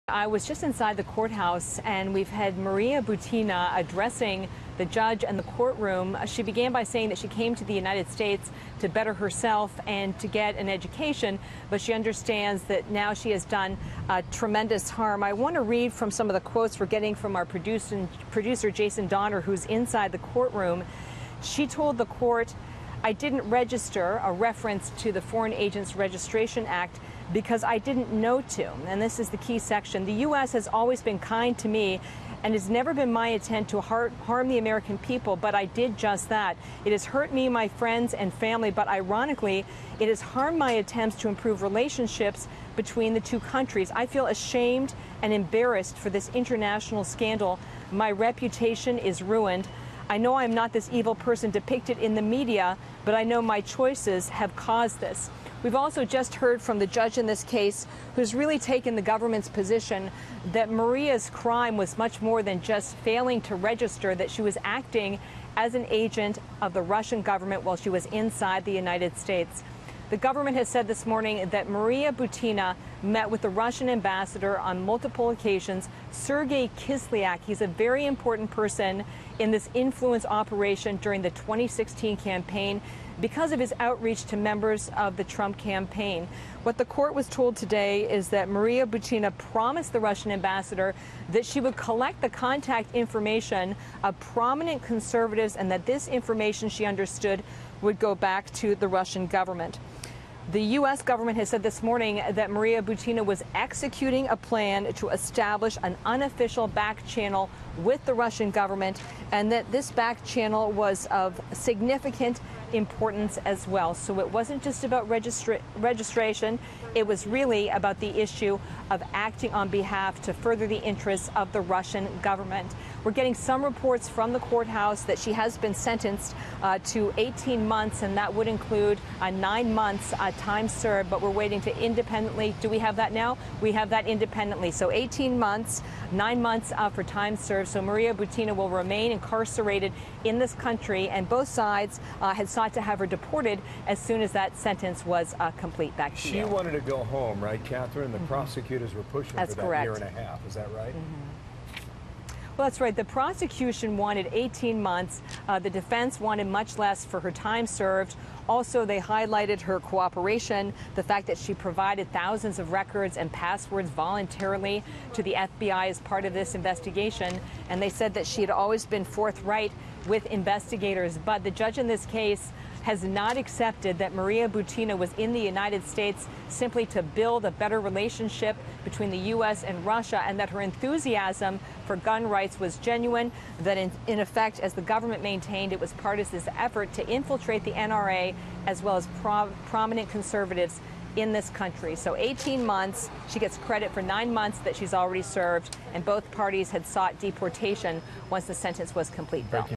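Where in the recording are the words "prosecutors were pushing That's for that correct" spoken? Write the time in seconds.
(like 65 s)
148 s.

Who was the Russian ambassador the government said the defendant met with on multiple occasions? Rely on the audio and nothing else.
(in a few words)
Sergei Kislyak.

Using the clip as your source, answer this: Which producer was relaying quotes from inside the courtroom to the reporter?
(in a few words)
Jason Donner.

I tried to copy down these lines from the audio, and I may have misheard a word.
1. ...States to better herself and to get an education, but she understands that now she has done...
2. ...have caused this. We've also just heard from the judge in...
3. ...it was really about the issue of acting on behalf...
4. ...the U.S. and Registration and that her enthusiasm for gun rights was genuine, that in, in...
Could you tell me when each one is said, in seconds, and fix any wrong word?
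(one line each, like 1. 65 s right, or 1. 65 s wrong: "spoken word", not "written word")
1. 8 s right
2. 54 s right
3. 116 s right
4. 179 s wrong: "Russia", not "Registration".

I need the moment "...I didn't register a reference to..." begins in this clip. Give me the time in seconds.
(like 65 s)
23 s.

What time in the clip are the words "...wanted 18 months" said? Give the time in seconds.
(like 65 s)
153 s.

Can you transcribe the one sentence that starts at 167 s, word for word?
And they said that she had always been forthright with investigators.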